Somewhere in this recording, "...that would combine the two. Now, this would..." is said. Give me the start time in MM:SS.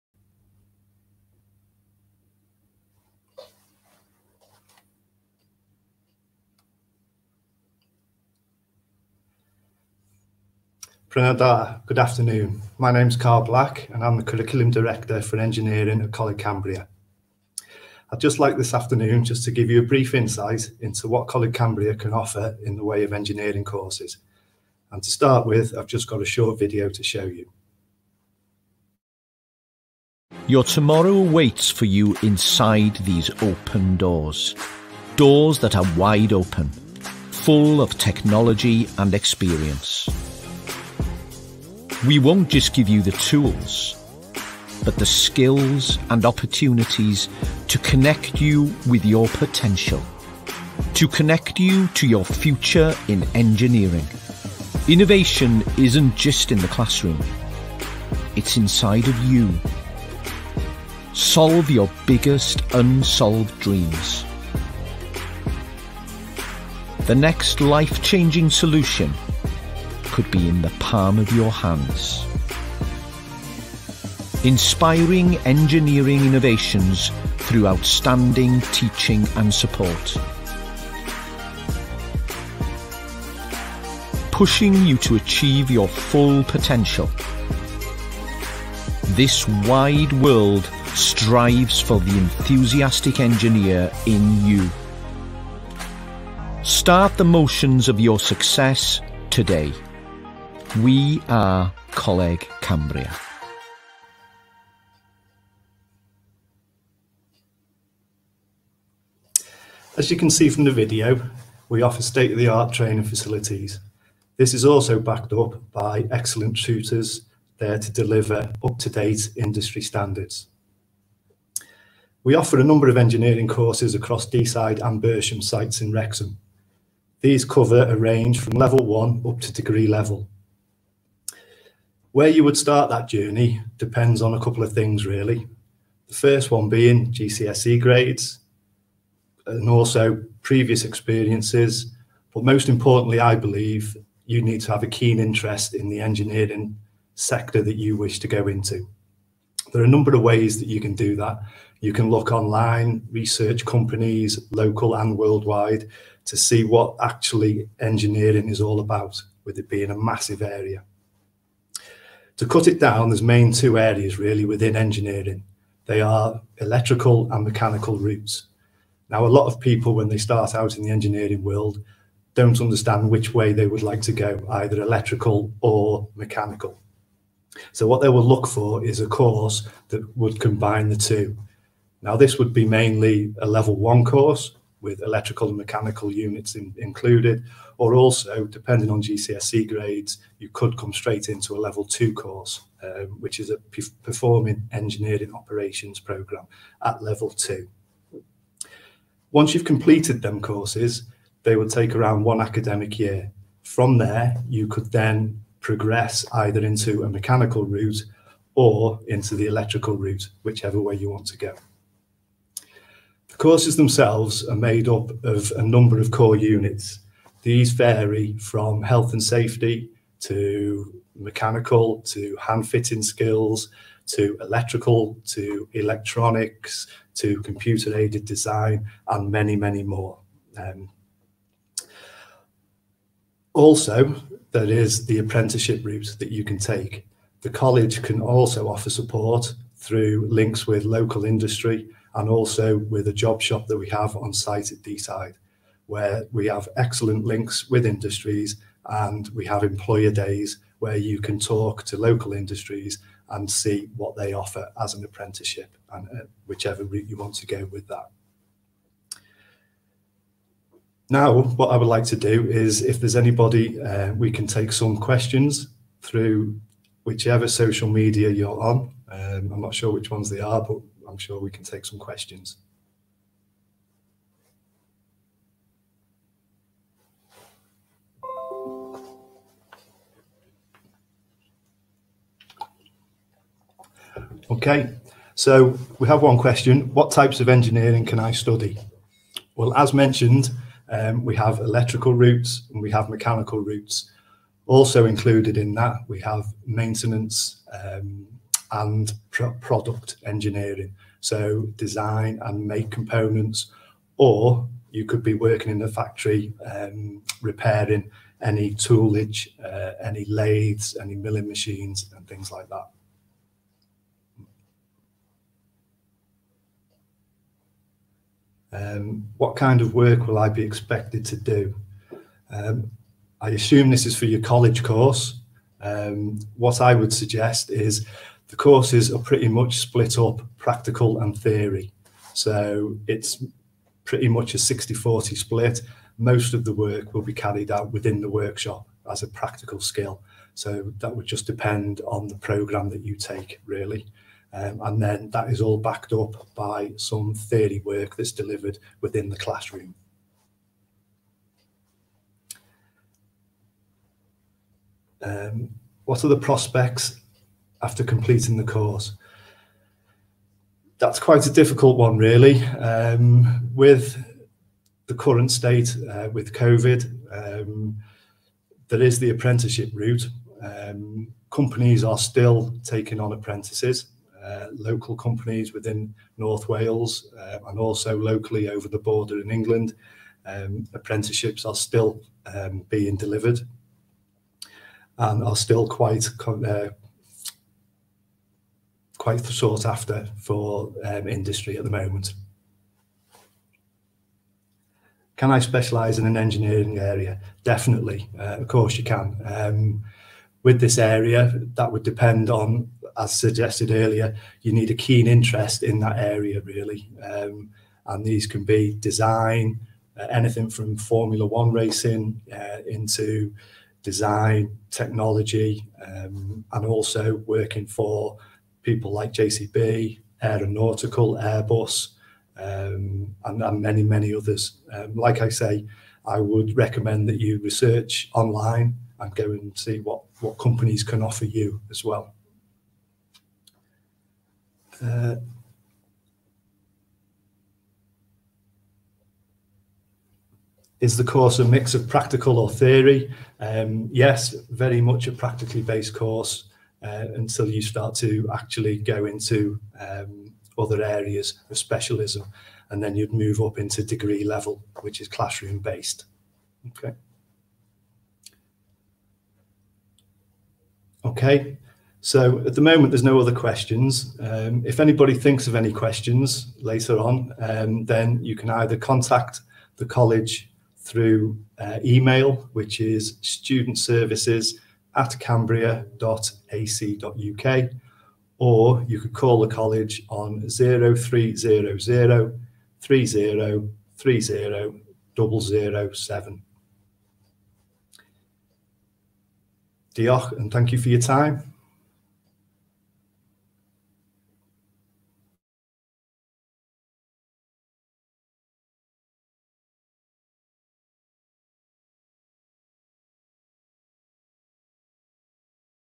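02:59.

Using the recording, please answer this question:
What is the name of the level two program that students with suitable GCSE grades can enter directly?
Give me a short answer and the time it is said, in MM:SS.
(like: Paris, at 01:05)
Performing Engineering Operations, at 03:14.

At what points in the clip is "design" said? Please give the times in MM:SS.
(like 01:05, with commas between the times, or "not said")
03:48, 05:01, 06:48, 06:54.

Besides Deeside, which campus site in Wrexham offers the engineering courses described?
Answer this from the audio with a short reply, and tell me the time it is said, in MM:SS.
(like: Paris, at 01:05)
Bersham, at 02:05.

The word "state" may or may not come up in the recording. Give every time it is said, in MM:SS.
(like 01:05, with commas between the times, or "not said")
01:52, 06:05.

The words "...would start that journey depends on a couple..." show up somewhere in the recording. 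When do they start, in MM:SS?
02:12.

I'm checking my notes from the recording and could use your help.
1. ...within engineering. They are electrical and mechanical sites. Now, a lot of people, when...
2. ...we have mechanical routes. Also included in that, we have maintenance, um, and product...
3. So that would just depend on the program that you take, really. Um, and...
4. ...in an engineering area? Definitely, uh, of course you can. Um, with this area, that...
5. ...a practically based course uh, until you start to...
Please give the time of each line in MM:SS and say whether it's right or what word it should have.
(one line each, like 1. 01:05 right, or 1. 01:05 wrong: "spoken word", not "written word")
1. 02:44 wrong: "routes", not "sites"
2. 04:52 right
3. 05:40 right
4. 06:36 right
5. 07:25 right.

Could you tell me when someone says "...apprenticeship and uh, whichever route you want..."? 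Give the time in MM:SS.
04:15.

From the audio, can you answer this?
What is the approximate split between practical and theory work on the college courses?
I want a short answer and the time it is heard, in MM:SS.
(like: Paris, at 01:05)
60-40, at 05:34.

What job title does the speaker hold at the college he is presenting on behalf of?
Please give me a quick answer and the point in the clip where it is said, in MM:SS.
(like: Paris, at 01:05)
Curriculum Director for Engineering, at 00:14.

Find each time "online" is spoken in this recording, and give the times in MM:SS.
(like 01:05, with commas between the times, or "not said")
02:32, 07:08.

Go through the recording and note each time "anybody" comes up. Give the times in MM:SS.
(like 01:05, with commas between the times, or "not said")
04:23, 07:44.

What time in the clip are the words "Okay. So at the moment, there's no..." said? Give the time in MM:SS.
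07:41.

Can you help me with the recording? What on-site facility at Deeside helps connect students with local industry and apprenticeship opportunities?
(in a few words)
job shop.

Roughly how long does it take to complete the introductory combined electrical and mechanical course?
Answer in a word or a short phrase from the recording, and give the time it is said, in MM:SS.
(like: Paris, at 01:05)
one academic year, at 03:22.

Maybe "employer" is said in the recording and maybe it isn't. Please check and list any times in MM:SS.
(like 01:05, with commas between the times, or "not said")
04:09.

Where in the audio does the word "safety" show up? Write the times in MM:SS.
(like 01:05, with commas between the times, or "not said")
03:39.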